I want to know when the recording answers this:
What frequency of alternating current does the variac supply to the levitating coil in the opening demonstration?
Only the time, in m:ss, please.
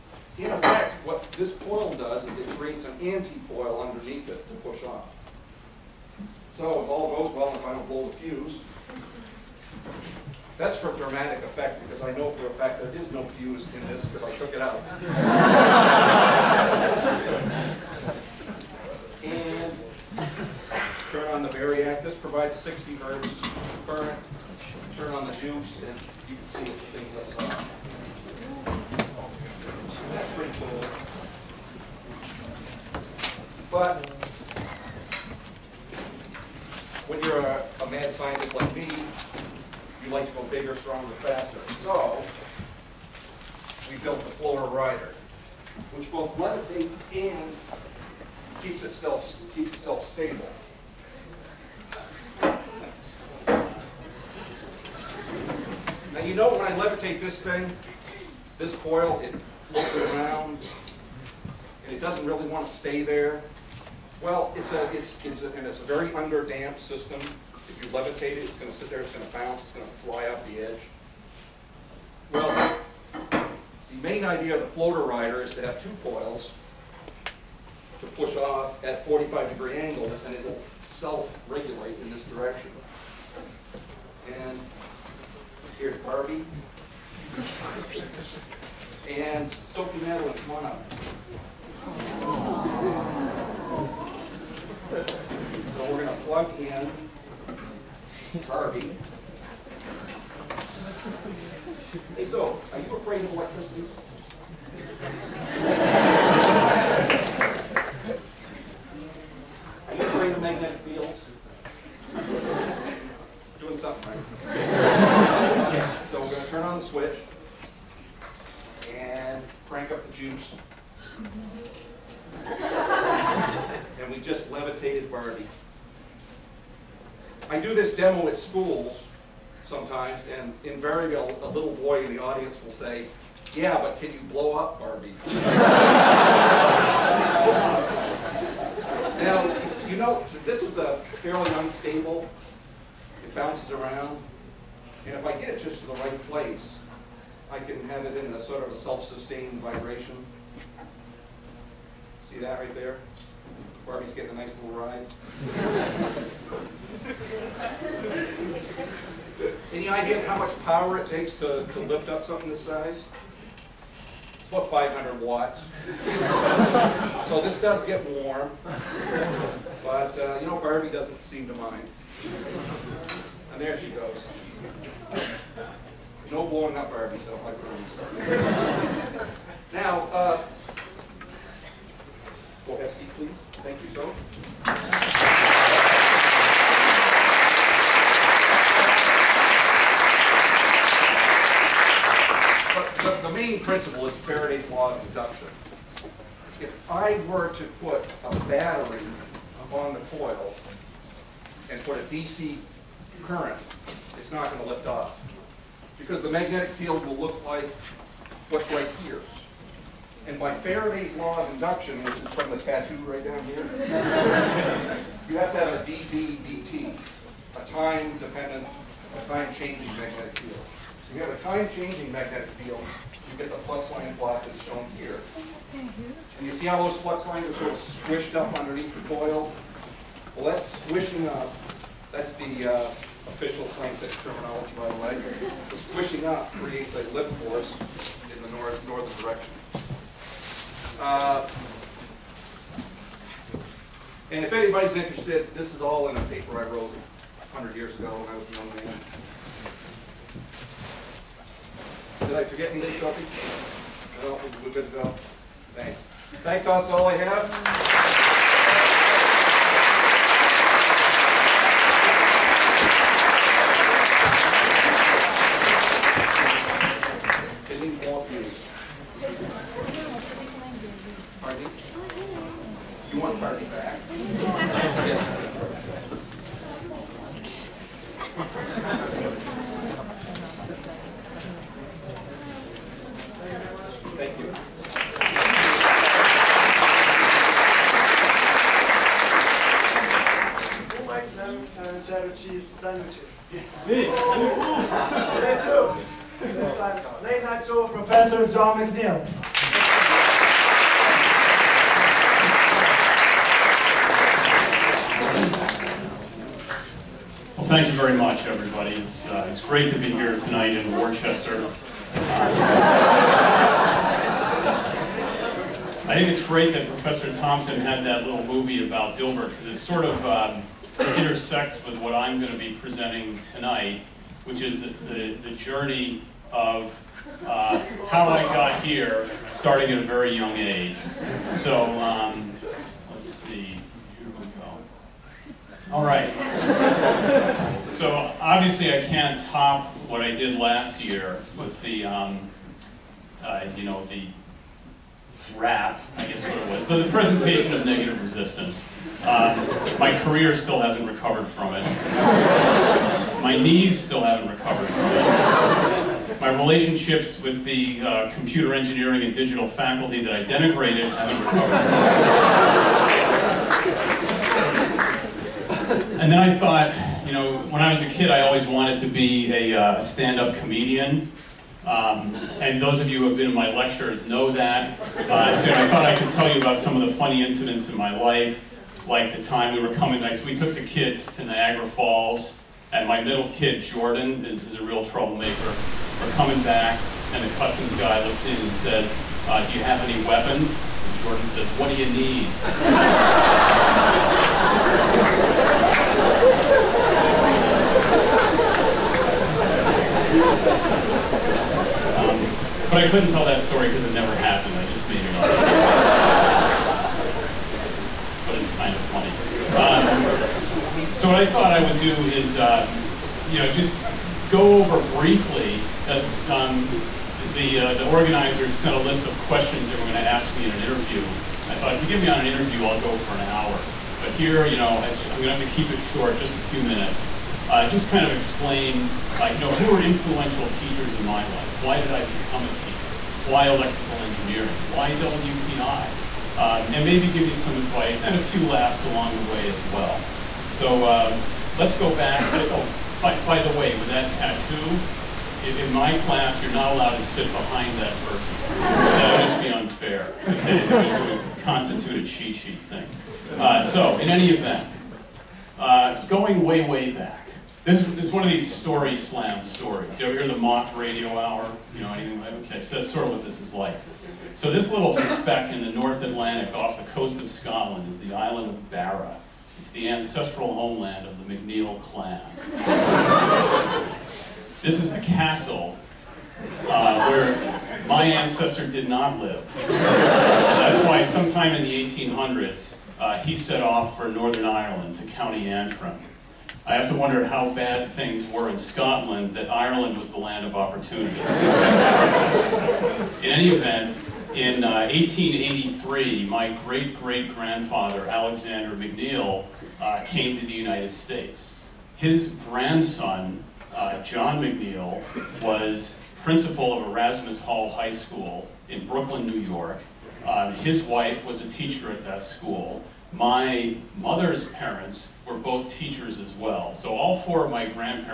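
0:22.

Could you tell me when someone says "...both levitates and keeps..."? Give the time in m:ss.
0:46.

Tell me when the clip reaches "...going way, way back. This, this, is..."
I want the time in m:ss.
7:36.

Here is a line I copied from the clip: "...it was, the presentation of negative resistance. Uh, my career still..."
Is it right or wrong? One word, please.
right.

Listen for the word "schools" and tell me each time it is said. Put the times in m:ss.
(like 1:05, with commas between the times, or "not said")
2:08, 8:28, 8:32.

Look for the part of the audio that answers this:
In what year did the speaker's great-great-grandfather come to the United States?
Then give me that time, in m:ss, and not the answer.
8:15.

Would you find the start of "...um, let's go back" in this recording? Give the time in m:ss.
7:21.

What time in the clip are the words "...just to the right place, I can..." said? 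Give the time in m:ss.
2:25.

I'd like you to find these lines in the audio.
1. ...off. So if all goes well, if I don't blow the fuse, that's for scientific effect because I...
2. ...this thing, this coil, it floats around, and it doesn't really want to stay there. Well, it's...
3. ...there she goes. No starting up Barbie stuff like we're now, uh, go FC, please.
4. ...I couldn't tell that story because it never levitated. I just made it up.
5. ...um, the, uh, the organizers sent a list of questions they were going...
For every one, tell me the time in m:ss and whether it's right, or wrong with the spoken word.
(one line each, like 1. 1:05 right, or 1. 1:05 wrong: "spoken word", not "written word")
1. 0:04 wrong: "dramatic", not "scientific"
2. 0:57 right
3. 2:53 wrong: "blowing", not "starting"
4. 6:43 wrong: "happened", not "levitated"
5. 6:56 right.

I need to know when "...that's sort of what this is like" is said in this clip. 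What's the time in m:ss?
7:42.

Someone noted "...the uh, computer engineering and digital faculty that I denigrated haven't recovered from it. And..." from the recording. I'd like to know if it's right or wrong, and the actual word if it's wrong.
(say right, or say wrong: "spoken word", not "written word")
right.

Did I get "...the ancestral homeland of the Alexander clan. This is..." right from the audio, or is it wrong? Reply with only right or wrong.
wrong.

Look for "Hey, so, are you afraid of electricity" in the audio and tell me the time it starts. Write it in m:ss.
1:42.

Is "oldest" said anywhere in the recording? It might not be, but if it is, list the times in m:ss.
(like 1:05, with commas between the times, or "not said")
not said.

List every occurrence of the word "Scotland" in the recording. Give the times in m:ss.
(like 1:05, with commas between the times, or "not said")
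7:47, 8:08.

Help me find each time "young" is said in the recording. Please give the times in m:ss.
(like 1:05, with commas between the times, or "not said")
4:08, 5:30.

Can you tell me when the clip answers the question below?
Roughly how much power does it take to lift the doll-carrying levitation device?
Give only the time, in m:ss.
2:44.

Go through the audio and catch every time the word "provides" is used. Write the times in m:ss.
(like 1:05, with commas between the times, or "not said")
0:22.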